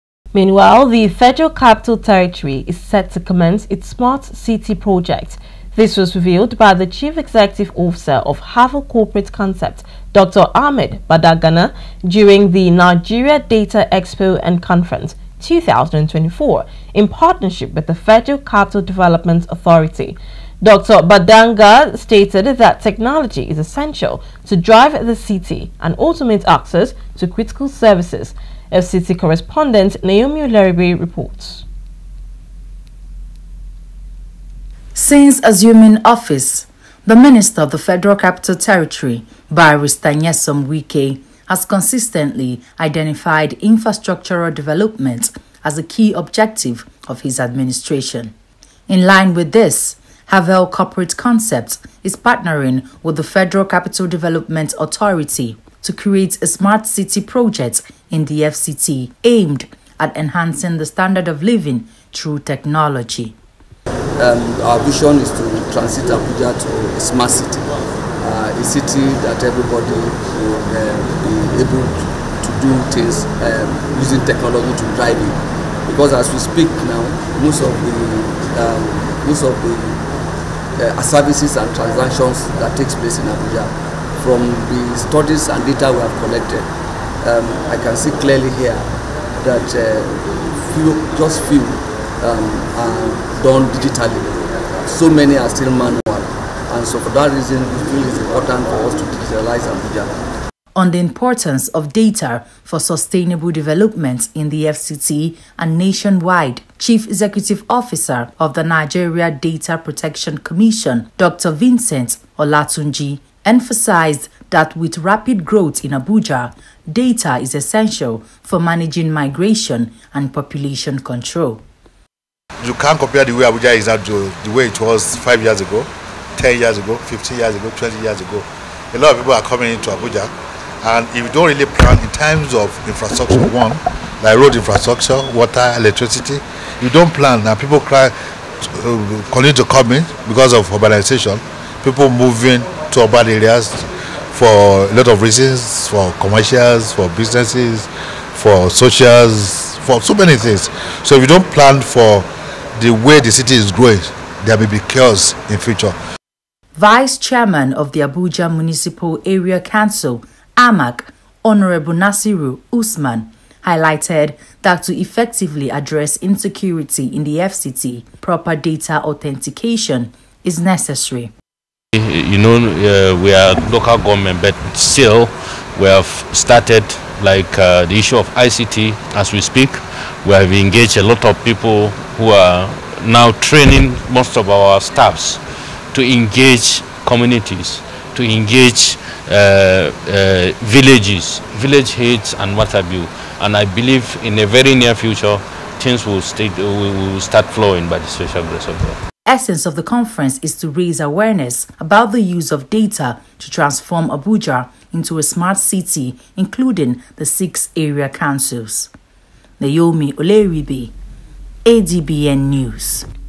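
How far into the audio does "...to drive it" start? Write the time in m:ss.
1:14.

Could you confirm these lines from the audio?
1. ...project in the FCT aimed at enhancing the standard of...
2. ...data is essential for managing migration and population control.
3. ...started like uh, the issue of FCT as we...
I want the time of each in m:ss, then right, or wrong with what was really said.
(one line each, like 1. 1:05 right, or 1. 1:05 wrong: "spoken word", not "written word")
1. 0:57 right
2. 1:56 right
3. 2:56 wrong: "ICT", not "FCT".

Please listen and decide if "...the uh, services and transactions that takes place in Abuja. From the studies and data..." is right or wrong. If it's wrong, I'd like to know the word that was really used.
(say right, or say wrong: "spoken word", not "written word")
right.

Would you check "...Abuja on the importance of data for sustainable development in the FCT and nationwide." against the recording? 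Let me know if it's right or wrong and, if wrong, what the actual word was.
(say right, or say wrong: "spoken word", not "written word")
right.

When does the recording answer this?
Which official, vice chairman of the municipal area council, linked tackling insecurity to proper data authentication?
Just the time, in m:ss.
2:41.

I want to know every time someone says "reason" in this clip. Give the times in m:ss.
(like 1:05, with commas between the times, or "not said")
1:37, 2:25.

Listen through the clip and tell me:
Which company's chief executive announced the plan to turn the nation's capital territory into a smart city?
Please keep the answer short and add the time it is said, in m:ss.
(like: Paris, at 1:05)
Havel Corporate Concept, at 0:08.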